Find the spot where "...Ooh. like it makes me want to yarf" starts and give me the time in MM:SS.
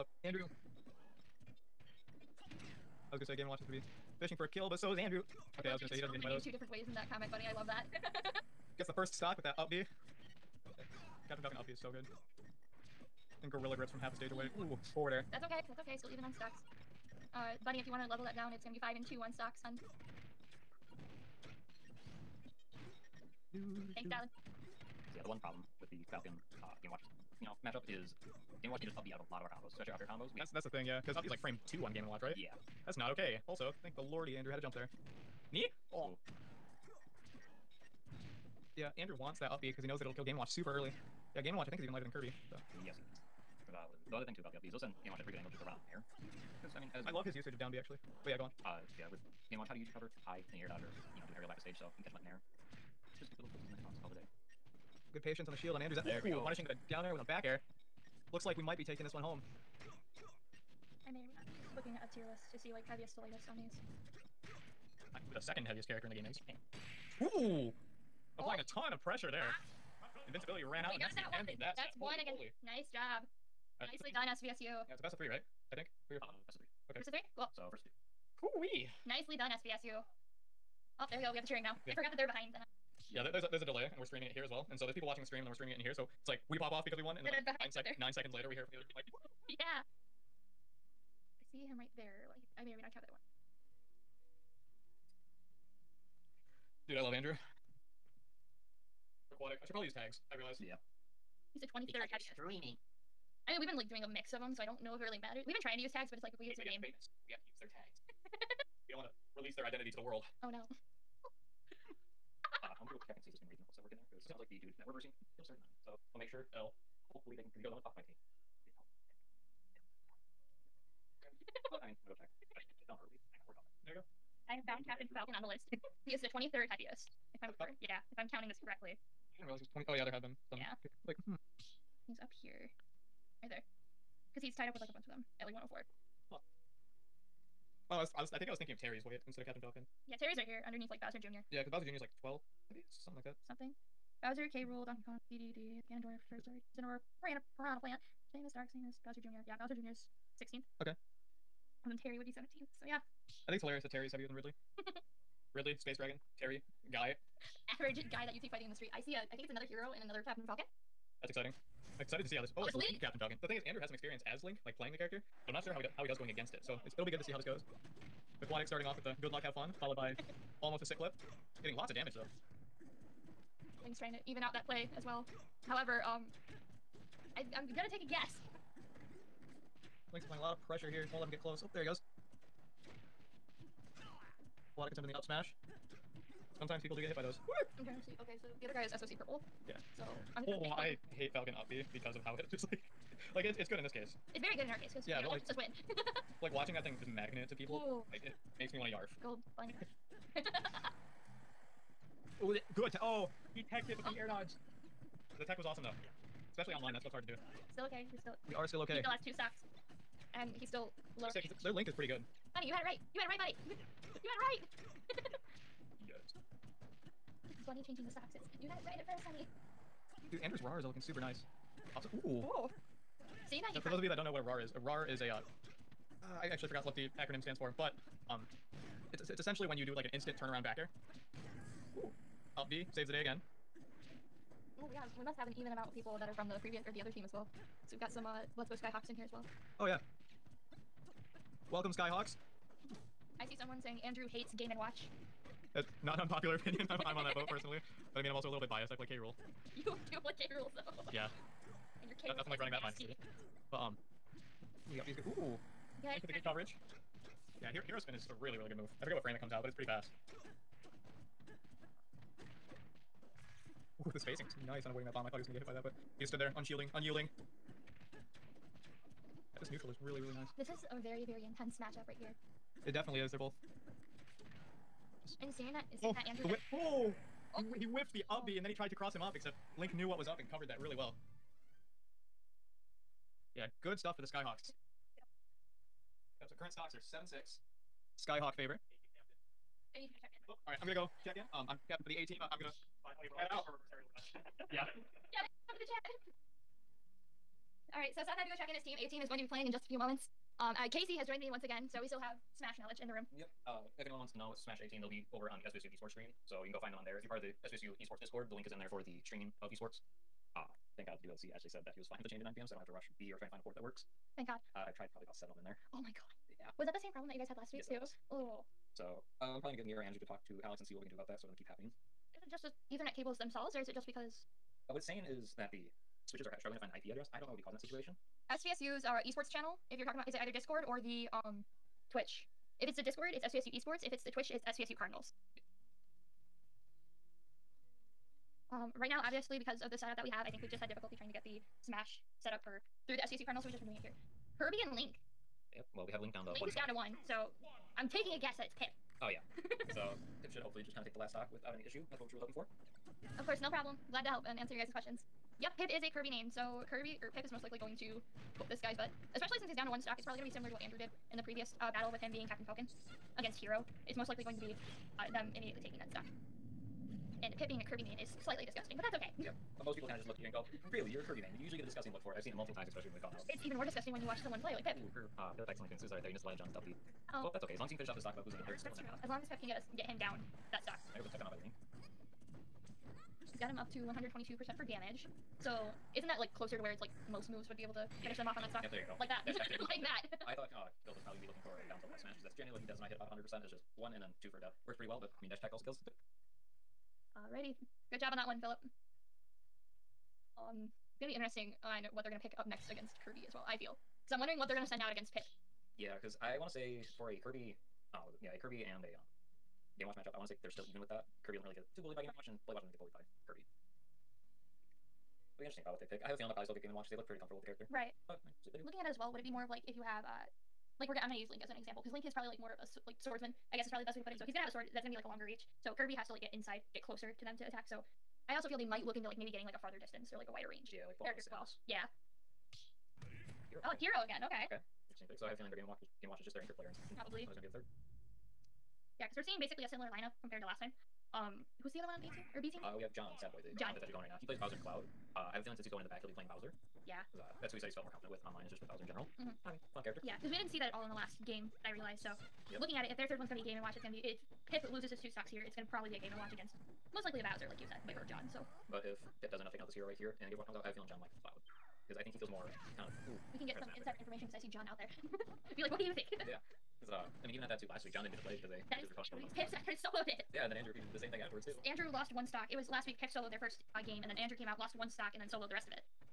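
03:17.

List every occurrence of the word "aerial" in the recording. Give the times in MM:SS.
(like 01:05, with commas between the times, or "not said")
00:51, 04:53.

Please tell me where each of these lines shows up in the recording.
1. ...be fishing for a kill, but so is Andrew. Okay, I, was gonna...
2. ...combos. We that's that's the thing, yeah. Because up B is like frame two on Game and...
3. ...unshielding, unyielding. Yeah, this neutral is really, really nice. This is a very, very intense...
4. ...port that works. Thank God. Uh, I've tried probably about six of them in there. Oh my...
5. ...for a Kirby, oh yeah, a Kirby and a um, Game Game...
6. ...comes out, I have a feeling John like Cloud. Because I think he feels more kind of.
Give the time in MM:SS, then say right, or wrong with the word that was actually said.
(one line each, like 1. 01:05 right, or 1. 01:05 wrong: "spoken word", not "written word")
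1. 00:03 right
2. 00:30 right
3. 04:26 right
4. 05:13 wrong: "seven", not "six"
5. 06:47 wrong: "Watch", not "Game"
6. 07:40 right.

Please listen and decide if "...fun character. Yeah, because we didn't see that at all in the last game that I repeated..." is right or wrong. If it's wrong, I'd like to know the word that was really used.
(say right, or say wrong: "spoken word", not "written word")
wrong: "realized", not "repeated".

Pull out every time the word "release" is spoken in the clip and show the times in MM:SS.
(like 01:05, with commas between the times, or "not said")
01:49.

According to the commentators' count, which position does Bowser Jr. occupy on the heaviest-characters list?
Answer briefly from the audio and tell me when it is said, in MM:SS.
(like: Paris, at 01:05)
16th, at 02:30.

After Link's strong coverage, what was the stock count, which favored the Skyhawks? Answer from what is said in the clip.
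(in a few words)
7 6.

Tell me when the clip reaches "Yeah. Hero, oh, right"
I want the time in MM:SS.
07:11.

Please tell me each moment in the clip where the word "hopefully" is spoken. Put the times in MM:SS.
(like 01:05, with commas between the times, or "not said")
01:57, 05:50.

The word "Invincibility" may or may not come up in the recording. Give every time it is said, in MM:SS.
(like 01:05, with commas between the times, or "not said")
01:10.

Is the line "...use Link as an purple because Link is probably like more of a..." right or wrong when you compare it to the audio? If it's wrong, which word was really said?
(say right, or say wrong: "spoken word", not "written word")
wrong: "example", not "purple".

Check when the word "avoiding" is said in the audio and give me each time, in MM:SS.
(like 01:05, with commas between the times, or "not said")
04:24.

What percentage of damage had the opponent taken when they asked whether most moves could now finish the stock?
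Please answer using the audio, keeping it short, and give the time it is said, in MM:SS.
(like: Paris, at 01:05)
122%, at 06:24.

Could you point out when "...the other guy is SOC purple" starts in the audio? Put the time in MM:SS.
03:08.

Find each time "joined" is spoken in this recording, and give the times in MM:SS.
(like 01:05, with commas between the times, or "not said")
05:01.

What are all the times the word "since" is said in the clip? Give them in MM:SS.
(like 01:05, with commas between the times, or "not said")
05:59, 07:25.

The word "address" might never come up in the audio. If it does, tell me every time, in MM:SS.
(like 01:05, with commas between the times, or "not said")
05:27.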